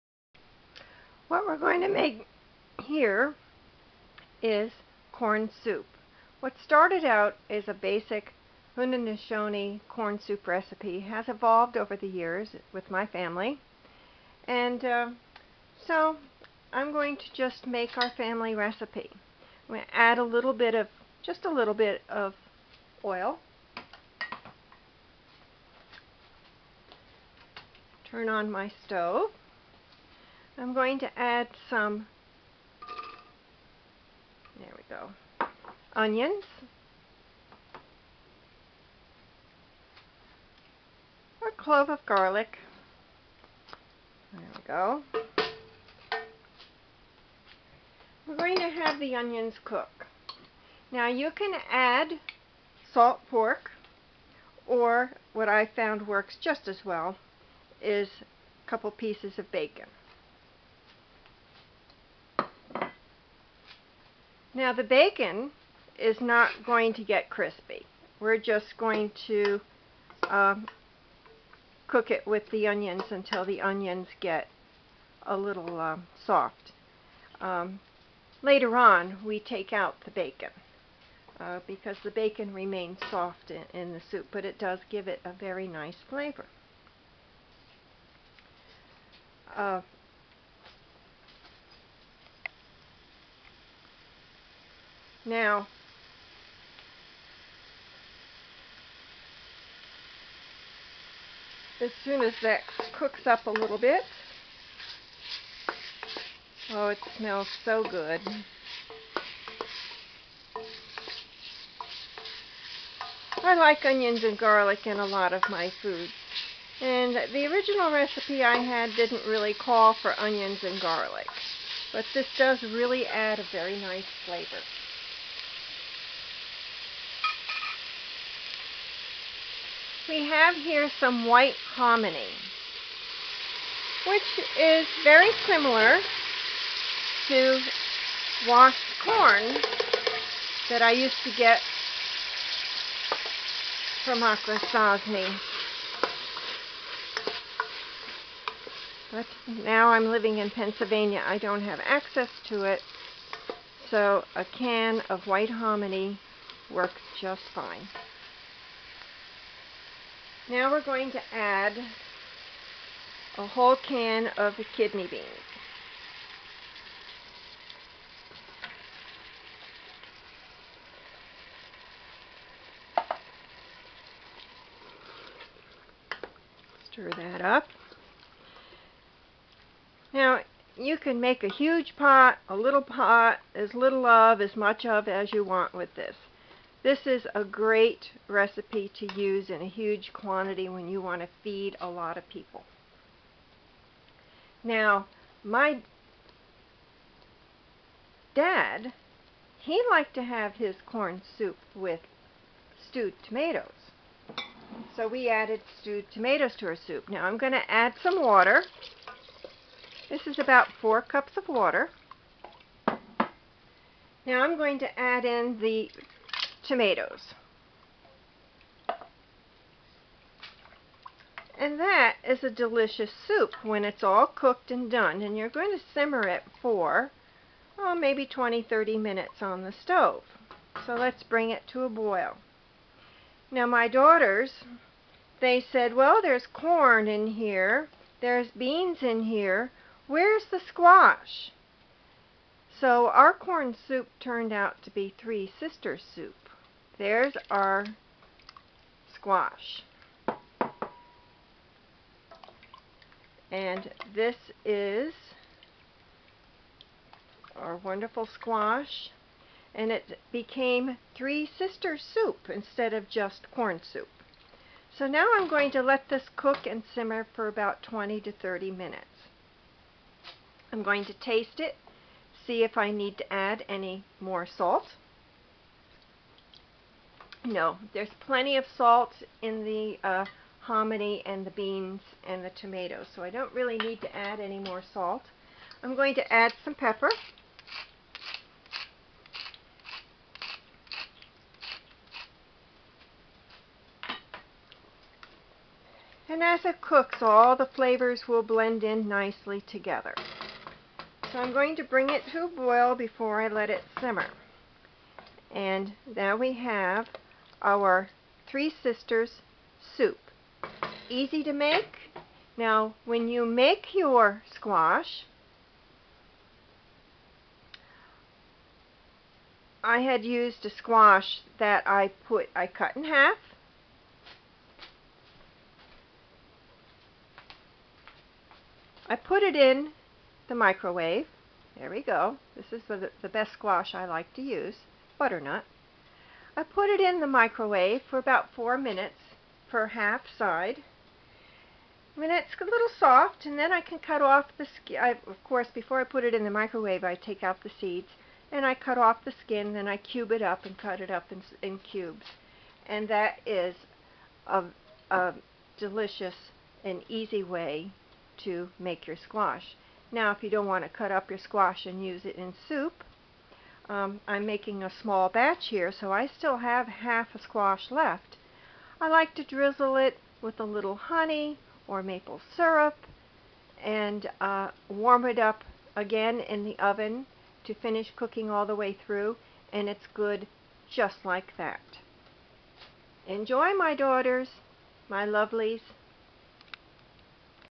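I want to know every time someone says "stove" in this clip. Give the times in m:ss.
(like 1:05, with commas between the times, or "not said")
0:28, 3:49.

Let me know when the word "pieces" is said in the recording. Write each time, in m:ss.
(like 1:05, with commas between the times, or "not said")
0:58.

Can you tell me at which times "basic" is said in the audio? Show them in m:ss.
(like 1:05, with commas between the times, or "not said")
0:07.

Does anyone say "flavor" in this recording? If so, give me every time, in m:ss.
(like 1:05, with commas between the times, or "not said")
1:26, 2:04, 4:57.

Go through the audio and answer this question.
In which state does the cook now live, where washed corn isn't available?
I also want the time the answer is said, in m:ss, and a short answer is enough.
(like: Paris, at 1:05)
Pennsylvania, at 2:30.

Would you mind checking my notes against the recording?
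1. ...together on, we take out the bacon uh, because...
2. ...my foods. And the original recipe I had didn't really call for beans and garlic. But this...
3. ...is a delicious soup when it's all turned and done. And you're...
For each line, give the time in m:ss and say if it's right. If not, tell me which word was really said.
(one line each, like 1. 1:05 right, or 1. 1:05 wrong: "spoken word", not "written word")
1. 1:18 wrong: "later", not "together"
2. 1:55 wrong: "onions", not "beans"
3. 3:42 wrong: "cooked", not "turned".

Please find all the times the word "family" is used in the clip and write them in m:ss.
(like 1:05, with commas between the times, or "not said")
0:13, 0:18.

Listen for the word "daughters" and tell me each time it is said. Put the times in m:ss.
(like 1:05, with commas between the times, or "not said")
3:53, 6:23.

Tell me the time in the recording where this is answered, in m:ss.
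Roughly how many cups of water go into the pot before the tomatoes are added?
3:30.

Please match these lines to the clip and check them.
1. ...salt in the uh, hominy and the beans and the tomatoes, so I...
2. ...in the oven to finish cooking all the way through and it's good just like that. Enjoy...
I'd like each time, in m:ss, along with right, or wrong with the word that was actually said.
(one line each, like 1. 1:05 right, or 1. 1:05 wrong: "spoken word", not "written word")
1. 4:38 right
2. 6:16 right.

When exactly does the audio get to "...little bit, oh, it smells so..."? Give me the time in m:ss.
1:43.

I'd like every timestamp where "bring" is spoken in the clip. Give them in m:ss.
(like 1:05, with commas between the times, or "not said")
3:51, 5:01.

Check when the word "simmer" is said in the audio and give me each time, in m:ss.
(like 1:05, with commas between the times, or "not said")
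3:45, 4:26, 5:03.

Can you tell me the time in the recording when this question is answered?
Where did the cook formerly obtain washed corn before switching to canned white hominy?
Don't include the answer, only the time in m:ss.
2:24.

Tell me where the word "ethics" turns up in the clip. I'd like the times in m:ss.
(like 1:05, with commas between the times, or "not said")
not said.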